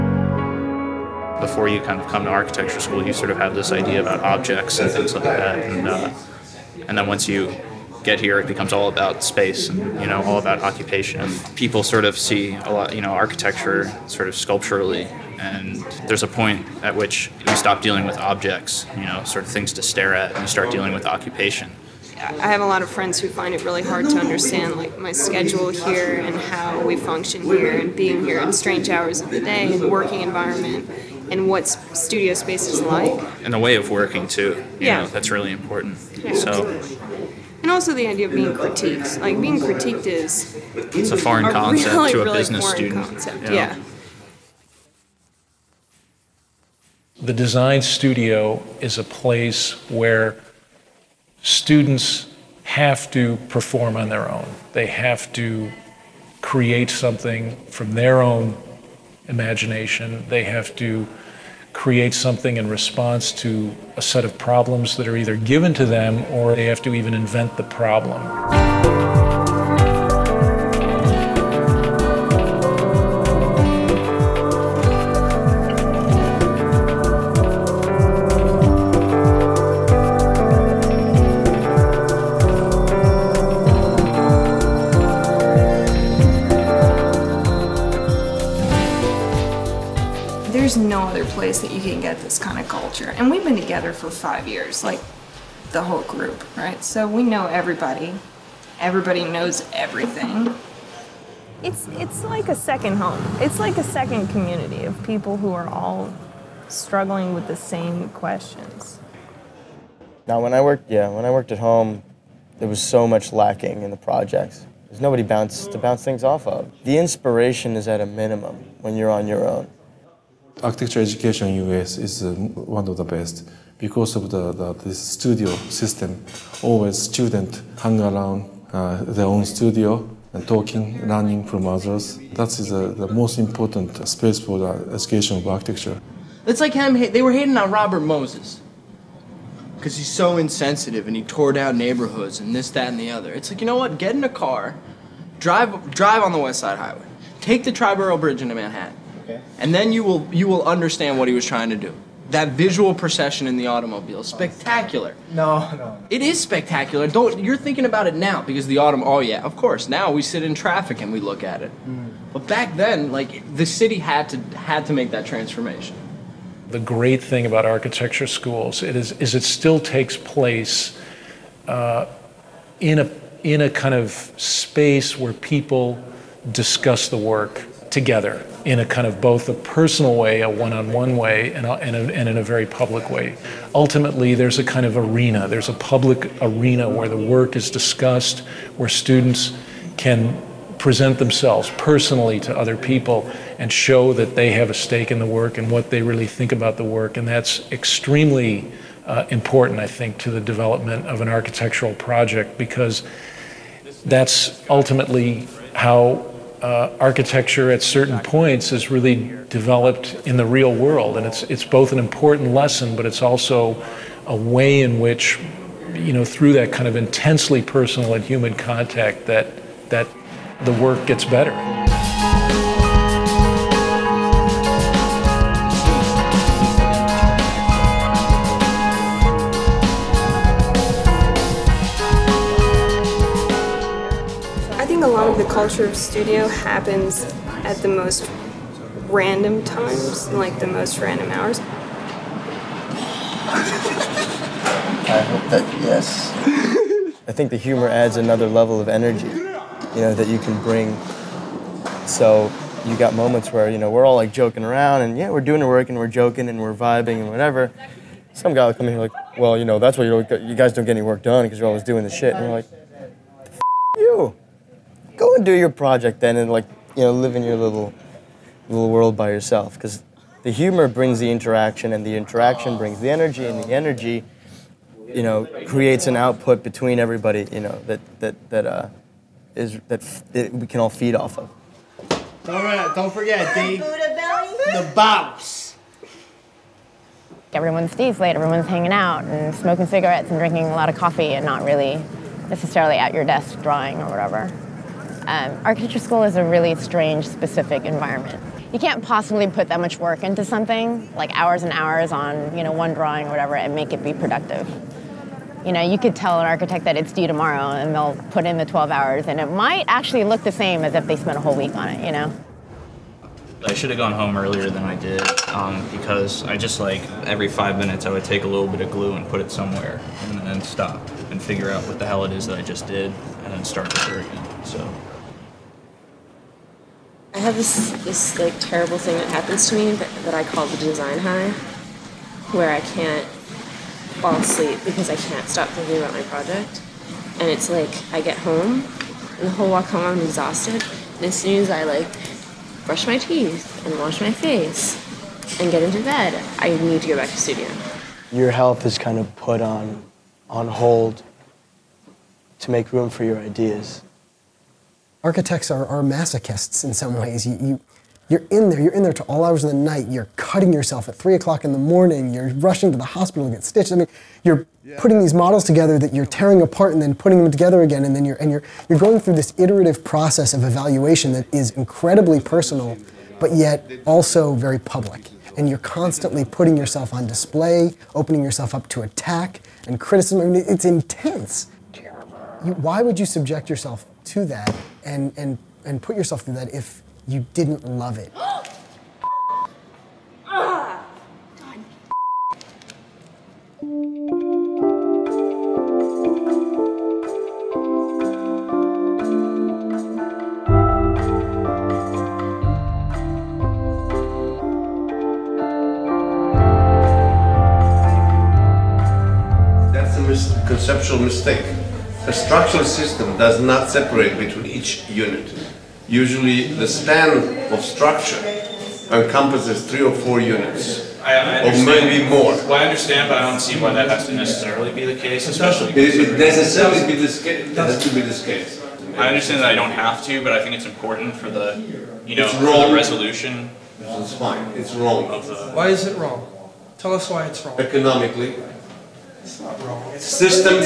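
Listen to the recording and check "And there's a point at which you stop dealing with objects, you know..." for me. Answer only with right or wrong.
right.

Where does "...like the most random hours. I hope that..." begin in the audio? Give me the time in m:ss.
4:00.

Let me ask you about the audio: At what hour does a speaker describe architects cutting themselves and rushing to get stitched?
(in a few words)
3 o'clock in the morning.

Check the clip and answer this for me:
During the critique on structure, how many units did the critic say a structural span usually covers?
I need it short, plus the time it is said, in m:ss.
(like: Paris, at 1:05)
3 or 4, at 6:59.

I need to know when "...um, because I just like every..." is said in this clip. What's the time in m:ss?
5:15.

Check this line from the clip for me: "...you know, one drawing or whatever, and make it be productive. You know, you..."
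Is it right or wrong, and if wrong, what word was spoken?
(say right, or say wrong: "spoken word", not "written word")
right.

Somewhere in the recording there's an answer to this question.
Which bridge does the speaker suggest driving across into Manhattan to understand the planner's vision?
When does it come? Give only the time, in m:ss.
2:27.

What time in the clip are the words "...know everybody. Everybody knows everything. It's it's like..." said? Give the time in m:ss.
1:37.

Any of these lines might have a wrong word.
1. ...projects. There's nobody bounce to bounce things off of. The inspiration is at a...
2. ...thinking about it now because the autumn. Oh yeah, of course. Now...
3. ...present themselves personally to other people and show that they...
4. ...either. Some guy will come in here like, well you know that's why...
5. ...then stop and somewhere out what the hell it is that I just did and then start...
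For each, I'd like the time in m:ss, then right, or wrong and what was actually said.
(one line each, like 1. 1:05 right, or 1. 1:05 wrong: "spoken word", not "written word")
1. 1:53 right
2. 2:37 right
3. 3:10 right
4. 4:17 wrong: "whatever", not "either"
5. 5:20 wrong: "figure", not "somewhere".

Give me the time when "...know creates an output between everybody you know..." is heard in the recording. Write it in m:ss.
4:35.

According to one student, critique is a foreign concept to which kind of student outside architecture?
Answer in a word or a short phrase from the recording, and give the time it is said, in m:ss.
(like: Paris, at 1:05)
business student, at 0:42.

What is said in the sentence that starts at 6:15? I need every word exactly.
And you're constantly putting yourself on display, opening yourself up to attack and criticism.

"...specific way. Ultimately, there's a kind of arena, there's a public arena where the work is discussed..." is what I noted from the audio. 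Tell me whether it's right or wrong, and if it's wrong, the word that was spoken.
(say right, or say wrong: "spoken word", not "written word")
wrong: "public", not "specific".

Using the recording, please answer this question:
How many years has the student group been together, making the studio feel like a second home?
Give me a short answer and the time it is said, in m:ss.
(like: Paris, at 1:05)
5, at 1:34.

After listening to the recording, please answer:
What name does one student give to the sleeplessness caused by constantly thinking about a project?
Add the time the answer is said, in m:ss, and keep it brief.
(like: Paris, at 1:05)
the design high, at 5:30.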